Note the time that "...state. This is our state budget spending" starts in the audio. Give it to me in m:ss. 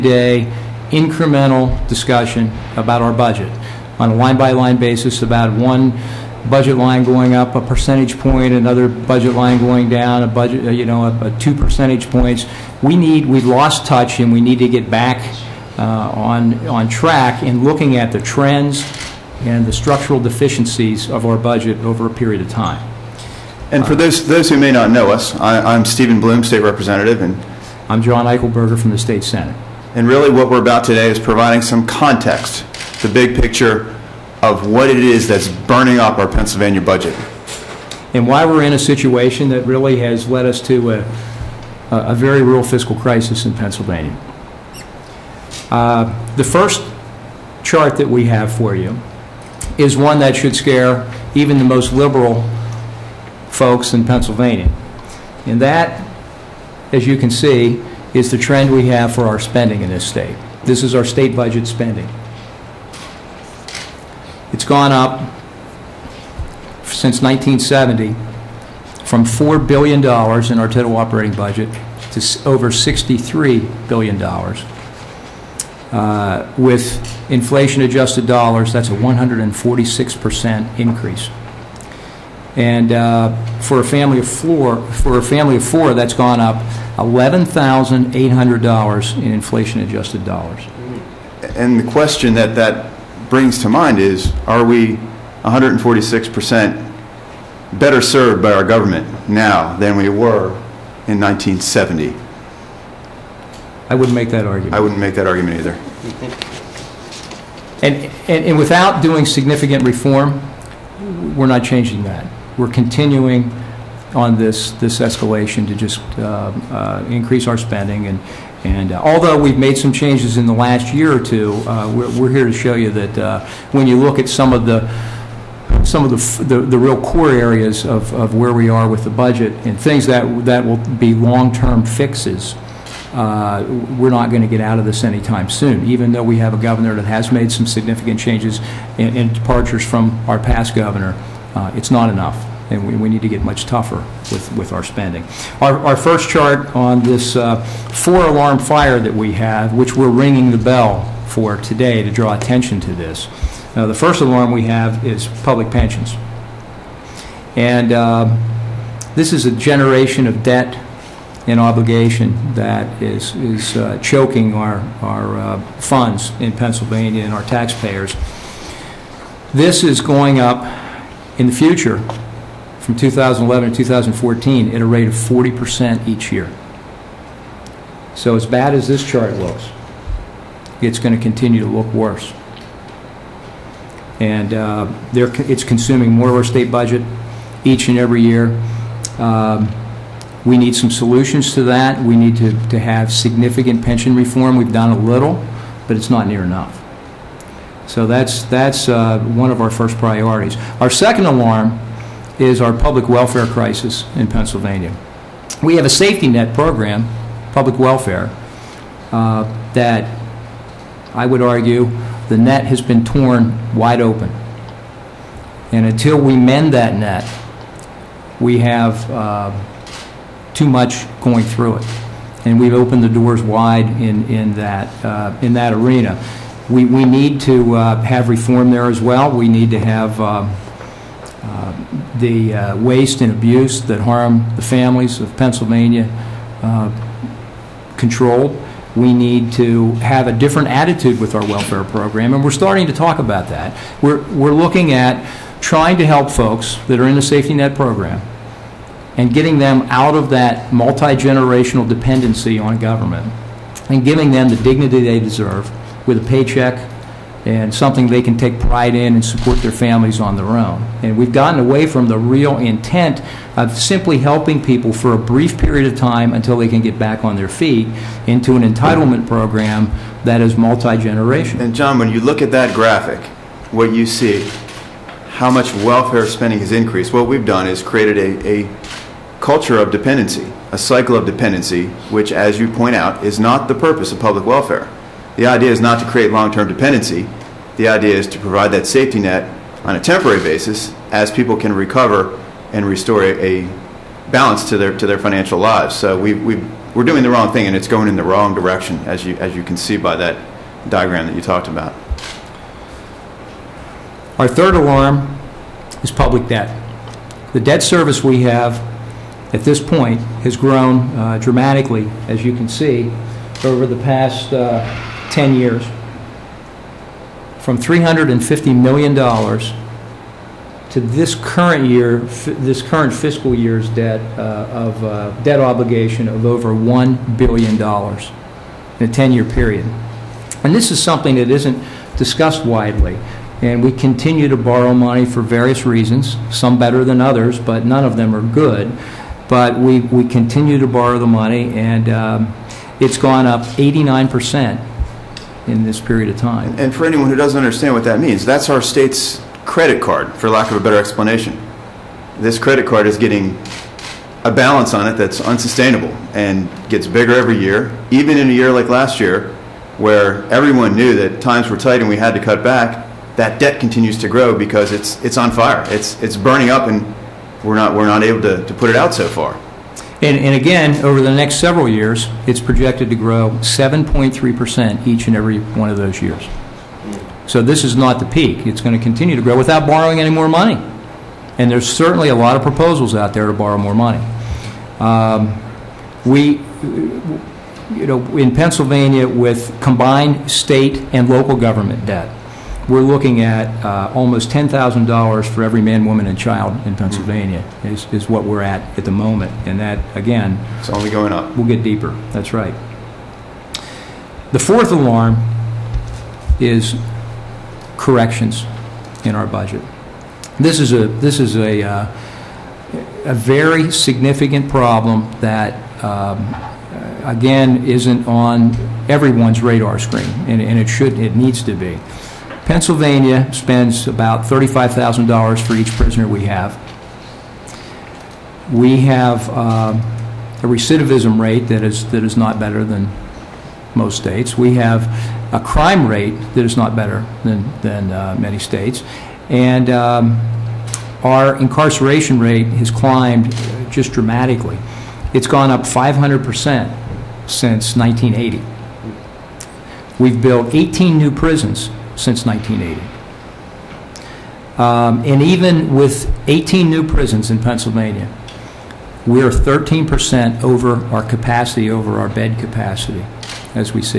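1:00.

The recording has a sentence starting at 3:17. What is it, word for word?
So that's, that's uh, one of our first priorities.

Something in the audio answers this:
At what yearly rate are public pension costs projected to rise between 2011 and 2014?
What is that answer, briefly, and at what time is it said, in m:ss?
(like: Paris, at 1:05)
40%, at 2:55.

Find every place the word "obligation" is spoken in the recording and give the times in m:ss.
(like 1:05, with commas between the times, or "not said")
2:41, 5:25.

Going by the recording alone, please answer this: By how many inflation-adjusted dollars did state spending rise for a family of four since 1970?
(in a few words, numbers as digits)
$11,800.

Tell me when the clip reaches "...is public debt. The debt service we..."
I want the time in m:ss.
5:06.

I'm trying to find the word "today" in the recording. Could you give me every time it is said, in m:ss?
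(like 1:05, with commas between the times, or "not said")
0:30, 2:31.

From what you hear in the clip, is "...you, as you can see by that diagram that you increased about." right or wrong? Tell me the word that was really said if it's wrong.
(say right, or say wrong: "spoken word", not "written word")
wrong: "talked", not "increased".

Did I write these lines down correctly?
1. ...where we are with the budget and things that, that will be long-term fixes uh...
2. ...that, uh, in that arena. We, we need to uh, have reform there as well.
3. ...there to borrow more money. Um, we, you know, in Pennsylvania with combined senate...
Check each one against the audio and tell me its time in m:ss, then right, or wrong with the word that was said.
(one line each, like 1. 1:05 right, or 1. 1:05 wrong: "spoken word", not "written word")
1. 2:08 right
2. 3:44 right
3. 6:23 wrong: "state", not "senate".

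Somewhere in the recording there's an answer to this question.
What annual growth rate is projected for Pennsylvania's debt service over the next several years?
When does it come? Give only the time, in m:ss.
6:13.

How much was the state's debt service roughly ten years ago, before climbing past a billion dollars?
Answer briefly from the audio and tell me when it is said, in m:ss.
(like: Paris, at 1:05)
$350 million, at 5:17.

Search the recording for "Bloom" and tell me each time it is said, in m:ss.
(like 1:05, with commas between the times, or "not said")
0:26.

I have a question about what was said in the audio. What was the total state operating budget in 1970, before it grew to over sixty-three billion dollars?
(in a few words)
$4 billion.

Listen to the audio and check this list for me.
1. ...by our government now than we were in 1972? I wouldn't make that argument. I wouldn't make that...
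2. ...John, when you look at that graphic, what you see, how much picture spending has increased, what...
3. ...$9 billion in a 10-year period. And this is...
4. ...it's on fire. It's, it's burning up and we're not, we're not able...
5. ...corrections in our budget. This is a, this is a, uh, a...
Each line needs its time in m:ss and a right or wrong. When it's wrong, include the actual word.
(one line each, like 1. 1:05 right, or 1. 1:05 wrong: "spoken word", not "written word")
1. 1:38 wrong: "1970", not "1972"
2. 4:31 wrong: "welfare", not "picture"
3. 5:26 wrong: "1", not "9"
4. 6:05 right
5. 6:47 right.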